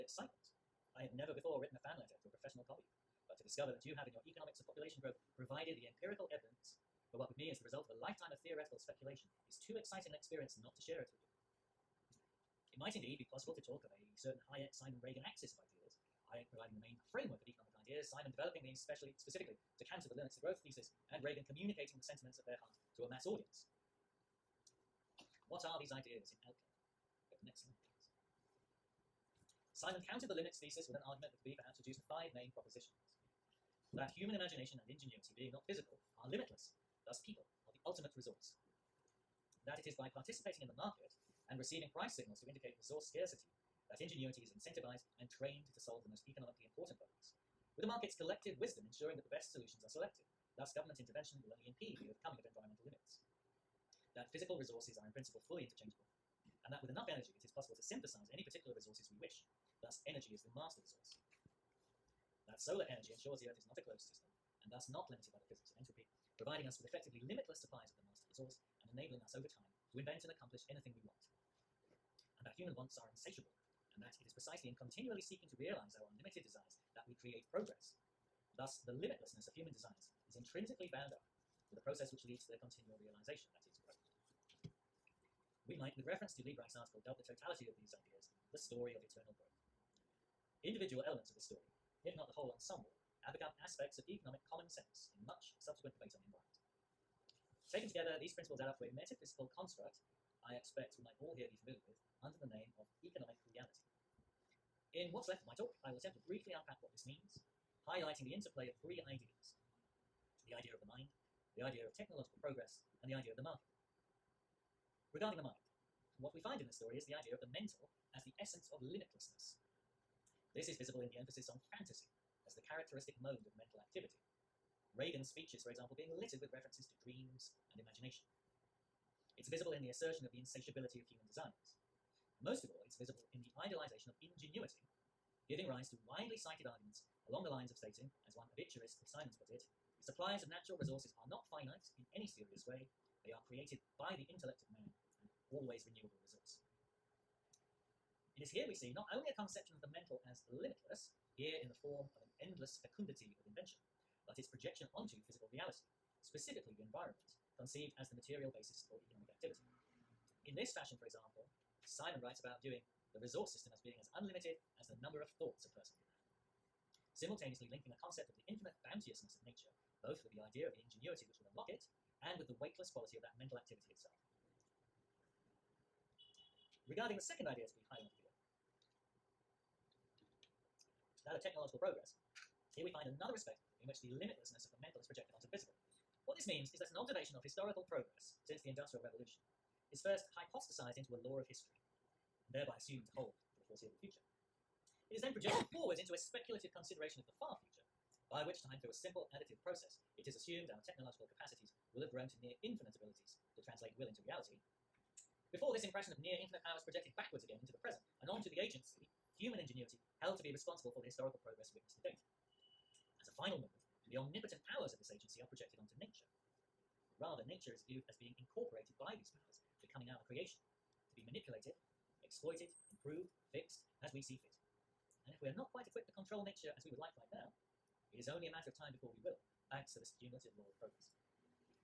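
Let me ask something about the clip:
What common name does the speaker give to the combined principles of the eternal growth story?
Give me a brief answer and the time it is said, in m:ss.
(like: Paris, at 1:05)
Economic reality, at 1:43.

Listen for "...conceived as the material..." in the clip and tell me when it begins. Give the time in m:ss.
2:37.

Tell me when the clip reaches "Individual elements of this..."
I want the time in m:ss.
1:30.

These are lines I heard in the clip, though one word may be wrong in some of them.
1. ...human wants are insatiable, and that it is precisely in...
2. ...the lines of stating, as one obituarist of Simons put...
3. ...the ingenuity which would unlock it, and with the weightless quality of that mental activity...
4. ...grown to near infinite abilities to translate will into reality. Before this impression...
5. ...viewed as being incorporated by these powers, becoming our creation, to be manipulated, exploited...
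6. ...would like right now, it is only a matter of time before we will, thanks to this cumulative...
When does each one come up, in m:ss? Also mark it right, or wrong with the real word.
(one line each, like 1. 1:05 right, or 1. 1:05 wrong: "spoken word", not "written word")
1. 1:12 right
2. 2:17 right
3. 2:50 right
4. 3:22 right
5. 3:37 right
6. 3:46 right.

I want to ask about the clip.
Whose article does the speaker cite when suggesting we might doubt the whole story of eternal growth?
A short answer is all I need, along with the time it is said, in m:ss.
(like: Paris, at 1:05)
Liebreich, at 1:26.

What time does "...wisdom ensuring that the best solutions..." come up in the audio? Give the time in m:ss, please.
0:48.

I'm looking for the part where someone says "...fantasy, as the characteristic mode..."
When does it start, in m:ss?
2:01.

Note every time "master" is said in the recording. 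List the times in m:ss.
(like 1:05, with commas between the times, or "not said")
1:00, 1:08.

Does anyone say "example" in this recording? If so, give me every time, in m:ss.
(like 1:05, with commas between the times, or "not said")
2:05, 2:41.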